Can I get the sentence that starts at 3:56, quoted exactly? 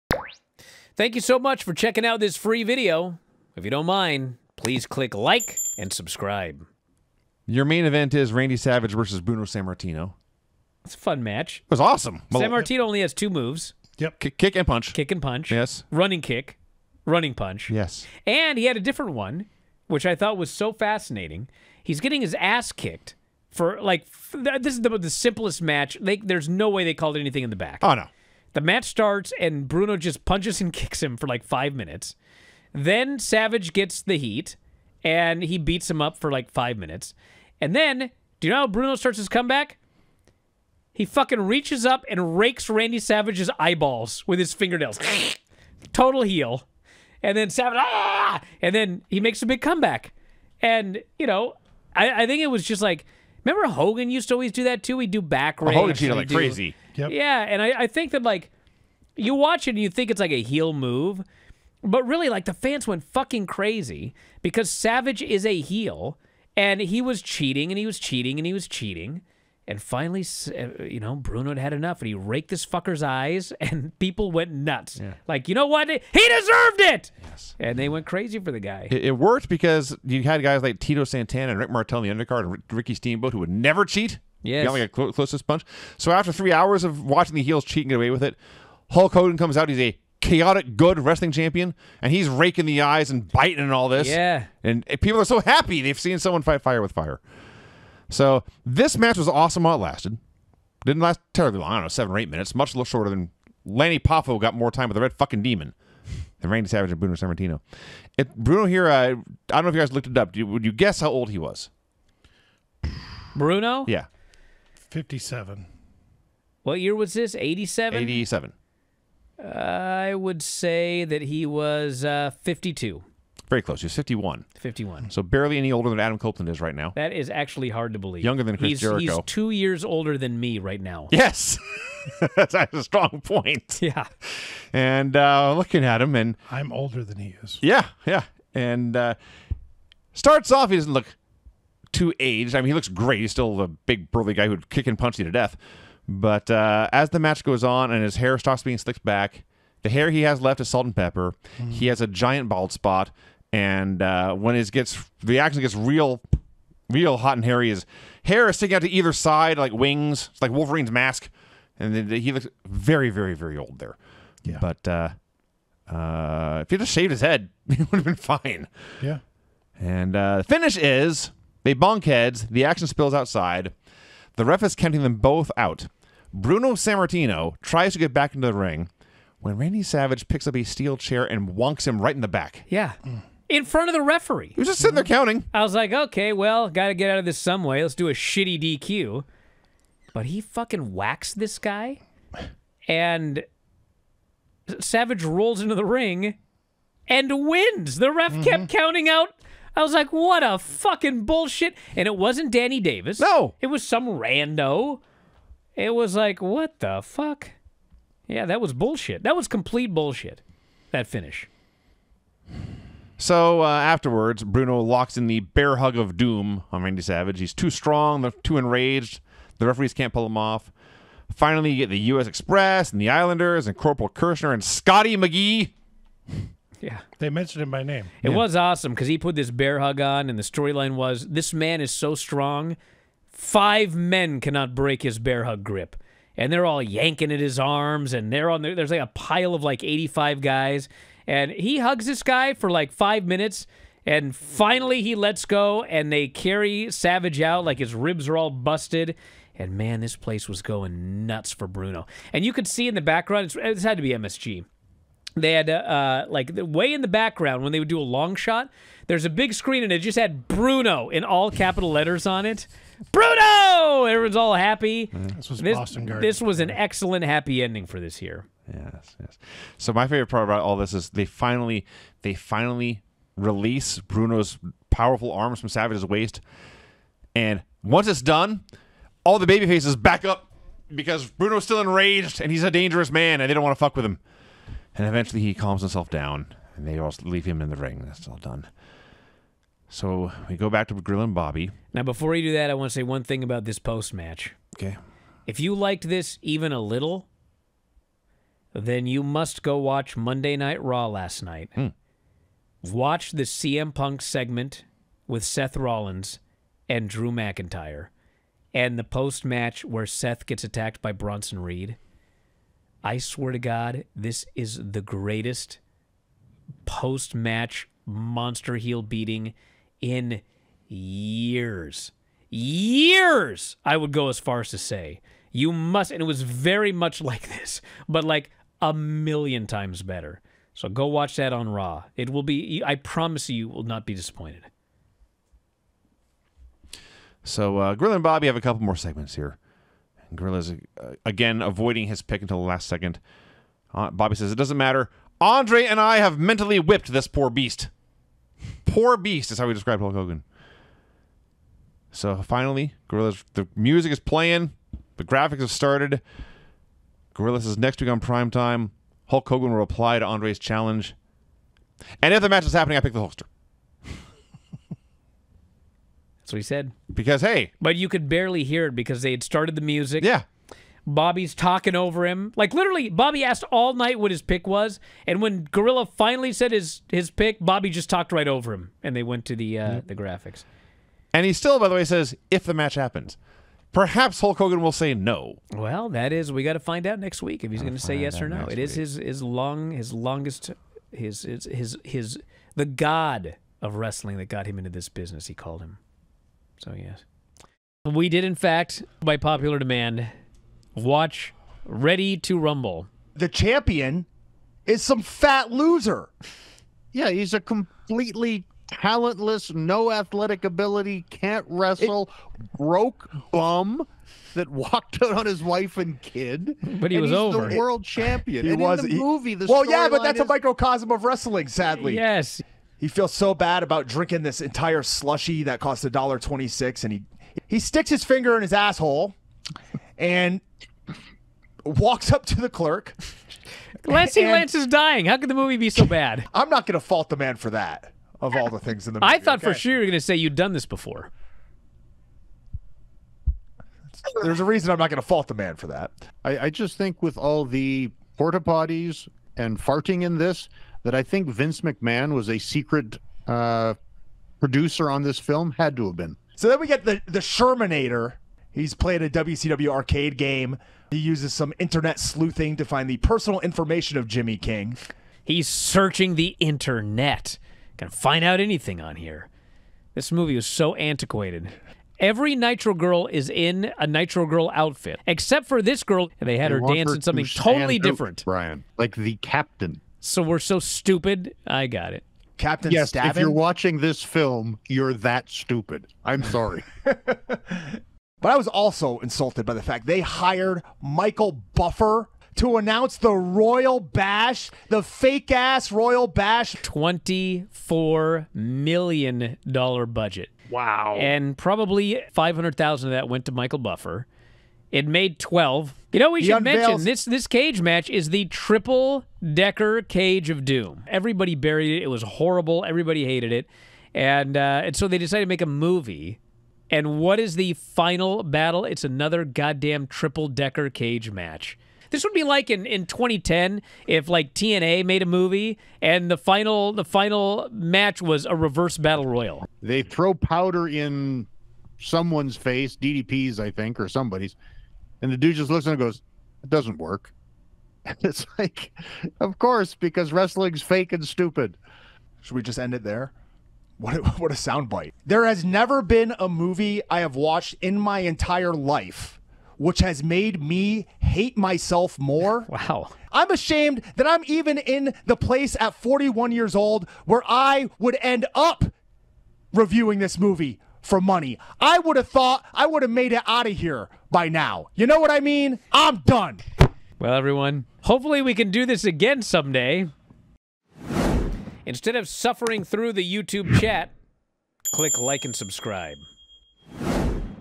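And they're all yanking at his arms, and they're on there.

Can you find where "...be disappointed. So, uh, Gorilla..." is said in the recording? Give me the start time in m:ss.
5:34.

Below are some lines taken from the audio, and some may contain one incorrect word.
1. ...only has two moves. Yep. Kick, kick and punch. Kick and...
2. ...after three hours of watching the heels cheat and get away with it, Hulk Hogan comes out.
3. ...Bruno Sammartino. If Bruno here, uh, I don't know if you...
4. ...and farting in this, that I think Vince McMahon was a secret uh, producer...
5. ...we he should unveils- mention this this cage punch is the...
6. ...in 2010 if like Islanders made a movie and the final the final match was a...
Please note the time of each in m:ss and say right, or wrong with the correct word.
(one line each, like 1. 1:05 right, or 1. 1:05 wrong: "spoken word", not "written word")
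1. 0:12 right
2. 1:26 right
3. 1:46 right
4. 7:29 right
5. 8:26 wrong: "match", not "punch"
6. 8:42 wrong: "TNA", not "Islanders".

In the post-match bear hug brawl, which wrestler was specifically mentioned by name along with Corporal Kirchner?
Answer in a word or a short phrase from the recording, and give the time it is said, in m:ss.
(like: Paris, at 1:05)
Scotty McGhee, at 3:44.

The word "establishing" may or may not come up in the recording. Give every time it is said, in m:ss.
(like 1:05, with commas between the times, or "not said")
not said.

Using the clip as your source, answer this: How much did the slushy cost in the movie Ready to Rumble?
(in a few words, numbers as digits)
$1.26.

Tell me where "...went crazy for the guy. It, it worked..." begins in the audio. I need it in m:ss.
1:17.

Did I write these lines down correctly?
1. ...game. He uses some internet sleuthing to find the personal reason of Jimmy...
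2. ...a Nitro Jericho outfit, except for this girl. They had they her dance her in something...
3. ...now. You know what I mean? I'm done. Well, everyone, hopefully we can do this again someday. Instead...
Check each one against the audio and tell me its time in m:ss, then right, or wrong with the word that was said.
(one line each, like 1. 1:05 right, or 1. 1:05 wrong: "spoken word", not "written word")
1. 7:40 wrong: "information", not "reason"
2. 7:53 wrong: "Girl", not "Jericho"
3. 9:24 right.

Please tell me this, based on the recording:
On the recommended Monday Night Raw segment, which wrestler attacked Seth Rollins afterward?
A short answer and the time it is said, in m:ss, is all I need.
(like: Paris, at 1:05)
Bronson Reed, at 5:11.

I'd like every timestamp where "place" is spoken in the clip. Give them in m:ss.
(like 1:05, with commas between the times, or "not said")
4:10, 9:15.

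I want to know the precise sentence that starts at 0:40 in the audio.
He fucking reaches up and rakes Randy Savage's eyeballs with his fingernails.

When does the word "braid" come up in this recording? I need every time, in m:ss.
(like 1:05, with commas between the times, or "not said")
not said.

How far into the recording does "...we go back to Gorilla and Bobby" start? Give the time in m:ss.
4:50.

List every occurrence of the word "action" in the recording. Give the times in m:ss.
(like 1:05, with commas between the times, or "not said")
2:35, 2:52.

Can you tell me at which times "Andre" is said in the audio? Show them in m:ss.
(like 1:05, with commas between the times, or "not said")
5:45, 6:00.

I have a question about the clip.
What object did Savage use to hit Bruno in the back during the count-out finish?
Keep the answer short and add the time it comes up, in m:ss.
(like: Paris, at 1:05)
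steel chair, at 3:00.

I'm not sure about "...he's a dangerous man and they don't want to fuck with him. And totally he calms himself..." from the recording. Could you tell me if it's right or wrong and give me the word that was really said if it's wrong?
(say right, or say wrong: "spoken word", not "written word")
wrong: "eventually", not "totally".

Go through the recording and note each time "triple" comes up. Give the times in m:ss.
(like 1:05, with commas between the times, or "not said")
8:28, 8:40.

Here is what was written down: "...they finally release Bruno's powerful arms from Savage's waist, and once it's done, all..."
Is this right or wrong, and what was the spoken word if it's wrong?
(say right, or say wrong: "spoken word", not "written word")
right.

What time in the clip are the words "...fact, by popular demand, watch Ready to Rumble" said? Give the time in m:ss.
6:38.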